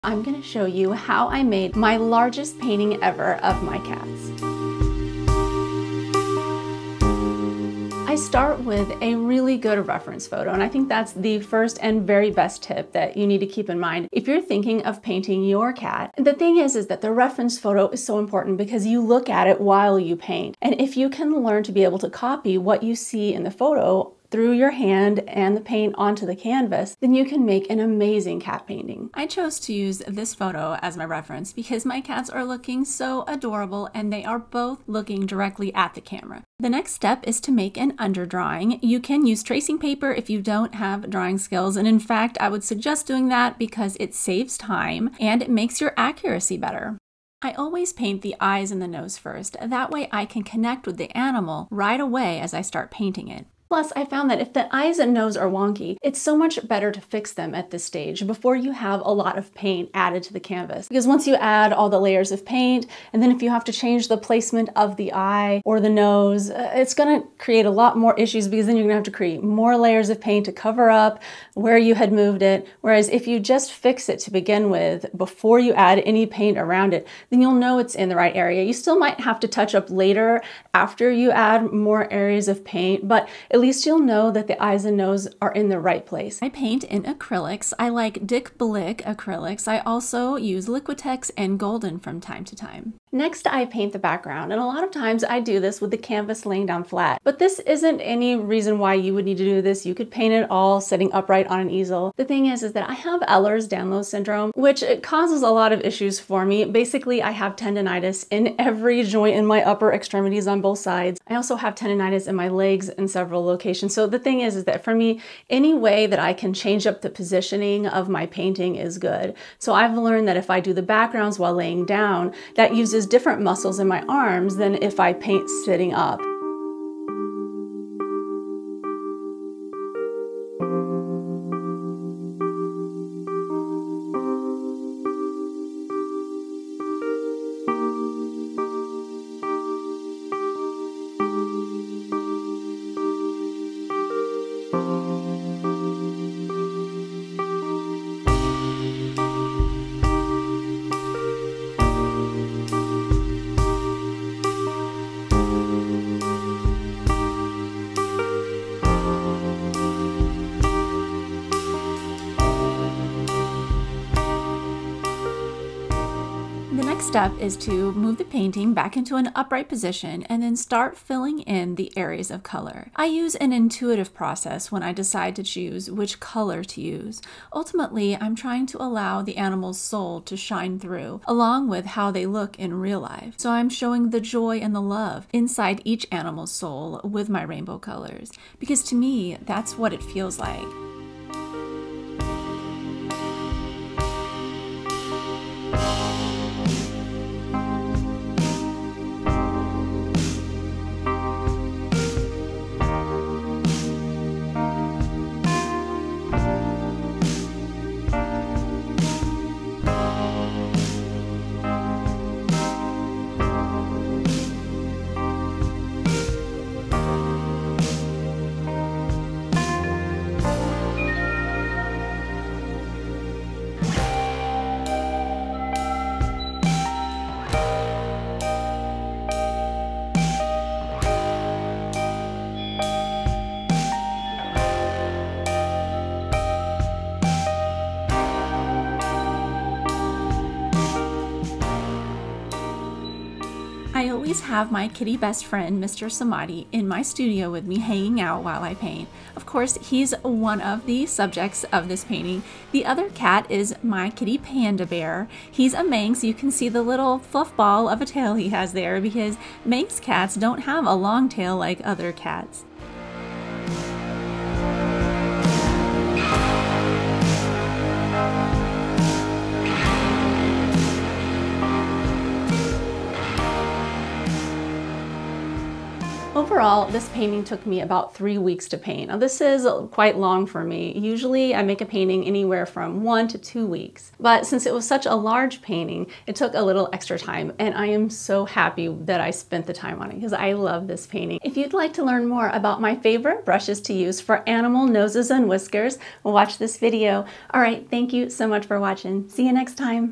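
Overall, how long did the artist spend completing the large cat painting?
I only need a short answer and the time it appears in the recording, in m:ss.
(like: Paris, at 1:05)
3 weeks, at 4:38.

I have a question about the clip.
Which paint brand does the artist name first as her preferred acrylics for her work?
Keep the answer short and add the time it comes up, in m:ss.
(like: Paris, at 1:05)
Dick Blick, at 1:28.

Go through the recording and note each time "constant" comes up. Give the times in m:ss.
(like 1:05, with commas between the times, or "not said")
not said.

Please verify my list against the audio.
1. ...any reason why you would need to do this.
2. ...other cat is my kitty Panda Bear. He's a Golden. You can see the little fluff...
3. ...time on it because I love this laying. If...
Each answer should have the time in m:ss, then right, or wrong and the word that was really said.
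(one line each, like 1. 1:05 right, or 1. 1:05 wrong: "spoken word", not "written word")
1. 1:37 right
2. 4:12 wrong: "Manx", not "Golden"
3. 4:49 wrong: "painting", not "laying".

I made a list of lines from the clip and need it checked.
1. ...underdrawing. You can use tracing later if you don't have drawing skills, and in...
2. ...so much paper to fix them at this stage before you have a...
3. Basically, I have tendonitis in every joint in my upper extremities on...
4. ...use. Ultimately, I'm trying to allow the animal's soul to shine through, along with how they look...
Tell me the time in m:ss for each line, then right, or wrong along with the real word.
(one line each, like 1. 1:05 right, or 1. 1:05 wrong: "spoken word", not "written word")
1. 0:37 wrong: "paper", not "later"
2. 0:56 wrong: "better", not "paper"
3. 1:46 right
4. 2:56 right.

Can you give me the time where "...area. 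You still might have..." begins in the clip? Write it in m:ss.
1:18.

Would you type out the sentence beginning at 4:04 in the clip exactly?
always have my kitty best friend, Mr.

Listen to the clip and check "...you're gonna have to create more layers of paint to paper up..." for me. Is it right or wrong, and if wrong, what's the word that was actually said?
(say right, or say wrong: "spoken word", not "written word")
wrong: "cover", not "paper".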